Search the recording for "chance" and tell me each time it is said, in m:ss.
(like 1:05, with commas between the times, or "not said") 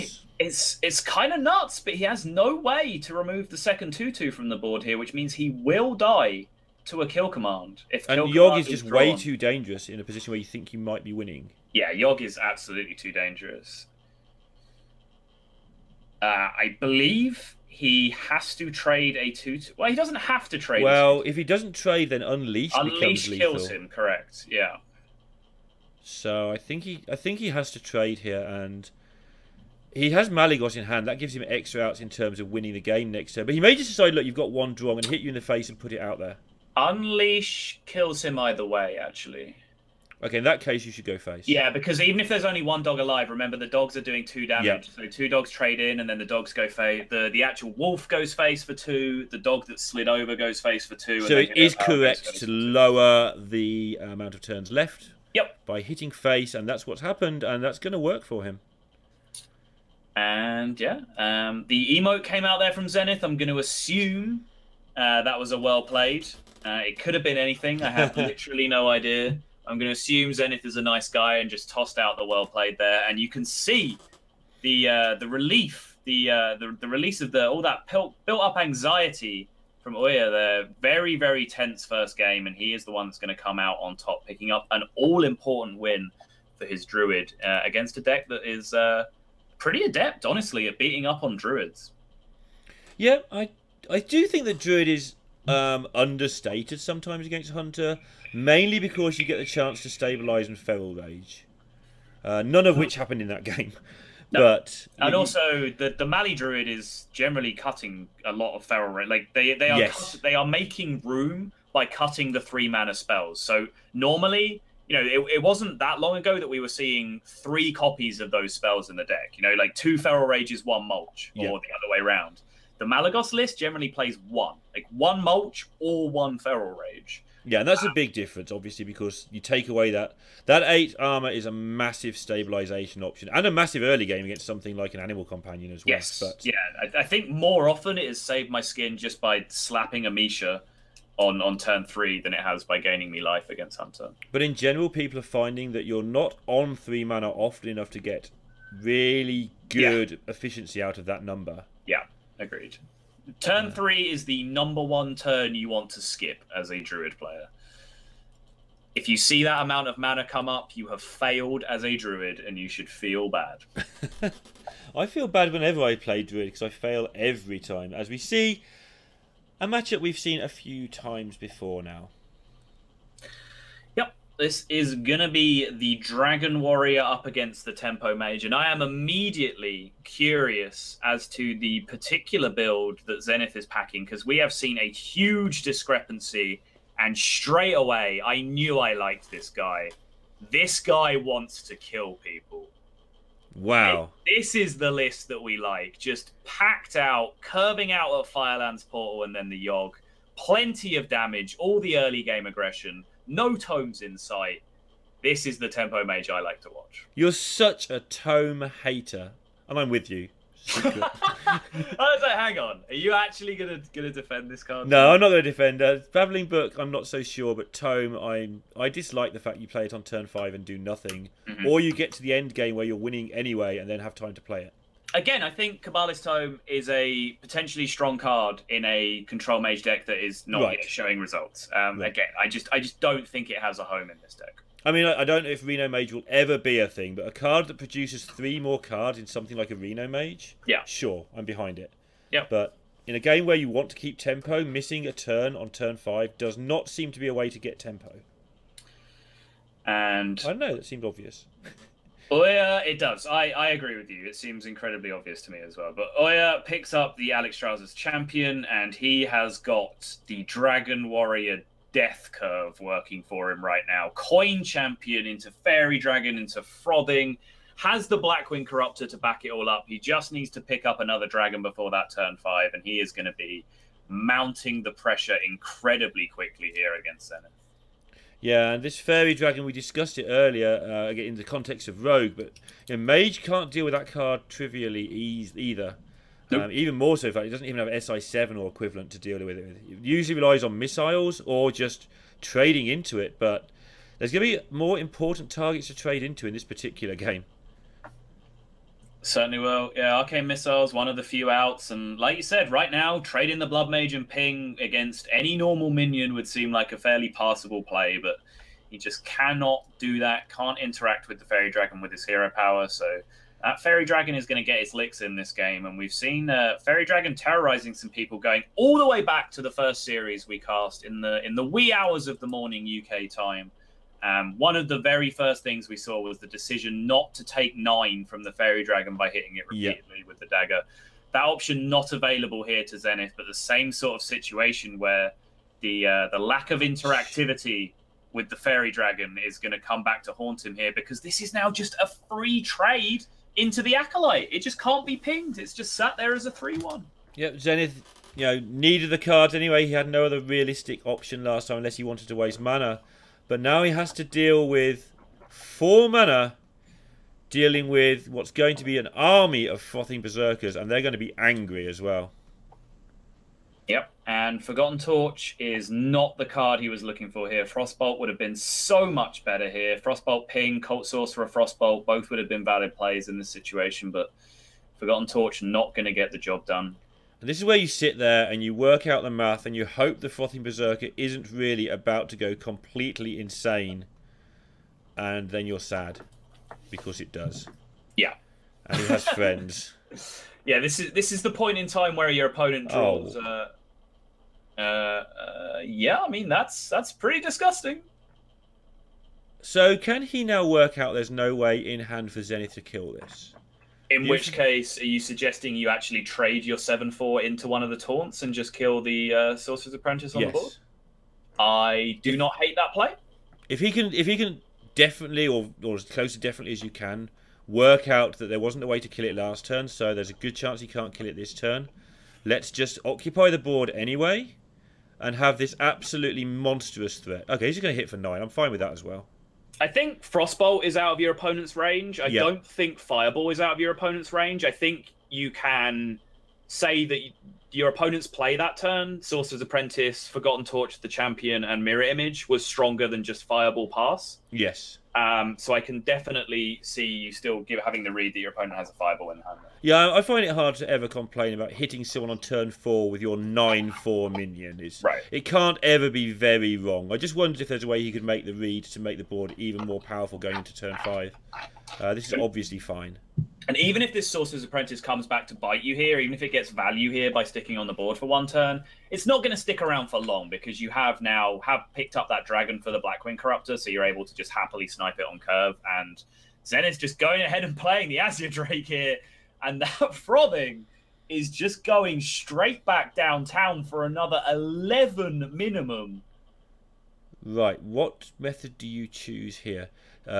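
1:39, 7:00.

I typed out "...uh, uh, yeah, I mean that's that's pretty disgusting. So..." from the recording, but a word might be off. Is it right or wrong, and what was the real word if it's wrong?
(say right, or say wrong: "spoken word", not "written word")
right.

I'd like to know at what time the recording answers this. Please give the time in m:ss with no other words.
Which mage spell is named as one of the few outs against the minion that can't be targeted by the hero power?
5:00.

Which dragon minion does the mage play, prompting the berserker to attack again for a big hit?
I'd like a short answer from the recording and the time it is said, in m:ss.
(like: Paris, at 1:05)
Azure Drake, at 7:58.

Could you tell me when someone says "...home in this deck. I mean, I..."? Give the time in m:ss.
3:53.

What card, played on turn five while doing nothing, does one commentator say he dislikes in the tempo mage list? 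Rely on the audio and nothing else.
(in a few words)
Cabalist Tome.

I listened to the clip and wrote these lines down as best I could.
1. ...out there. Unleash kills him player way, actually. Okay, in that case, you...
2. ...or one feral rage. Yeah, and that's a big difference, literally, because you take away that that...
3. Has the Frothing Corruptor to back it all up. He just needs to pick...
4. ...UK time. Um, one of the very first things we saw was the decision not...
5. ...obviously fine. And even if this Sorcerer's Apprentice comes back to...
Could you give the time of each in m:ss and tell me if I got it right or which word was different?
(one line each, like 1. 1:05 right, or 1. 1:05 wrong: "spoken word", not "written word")
1. 0:36 wrong: "either", not "player"
2. 2:05 wrong: "obviously", not "literally"
3. 4:27 wrong: "Blackwing", not "Frothing"
4. 5:23 right
5. 7:42 right.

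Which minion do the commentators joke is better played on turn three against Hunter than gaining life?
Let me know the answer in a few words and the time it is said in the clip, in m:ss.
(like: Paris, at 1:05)
Amisha, at 2:20.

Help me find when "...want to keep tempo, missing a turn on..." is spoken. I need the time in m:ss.
4:03.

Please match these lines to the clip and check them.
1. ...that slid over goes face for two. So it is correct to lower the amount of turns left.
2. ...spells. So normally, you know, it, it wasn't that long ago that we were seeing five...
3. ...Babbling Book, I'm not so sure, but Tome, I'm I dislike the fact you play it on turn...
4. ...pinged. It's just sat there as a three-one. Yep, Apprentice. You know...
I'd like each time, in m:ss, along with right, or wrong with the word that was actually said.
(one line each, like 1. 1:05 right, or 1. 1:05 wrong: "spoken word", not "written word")
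1. 0:49 right
2. 1:52 wrong: "three", not "five"
3. 3:36 right
4. 5:45 wrong: "Zenith", not "Apprentice".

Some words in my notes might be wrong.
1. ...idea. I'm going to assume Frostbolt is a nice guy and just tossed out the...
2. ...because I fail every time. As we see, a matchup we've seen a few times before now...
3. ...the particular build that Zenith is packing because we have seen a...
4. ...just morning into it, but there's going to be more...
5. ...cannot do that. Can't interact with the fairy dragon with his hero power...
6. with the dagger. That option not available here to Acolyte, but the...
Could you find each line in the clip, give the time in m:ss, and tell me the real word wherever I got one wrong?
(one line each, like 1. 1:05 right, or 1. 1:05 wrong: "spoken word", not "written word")
1. 1:08 wrong: "Zenith", not "Frostbolt"
2. 2:46 right
3. 3:01 right
4. 4:51 wrong: "trading", not "morning"
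5. 5:09 right
6. 5:30 wrong: "Zenith", not "Acolyte".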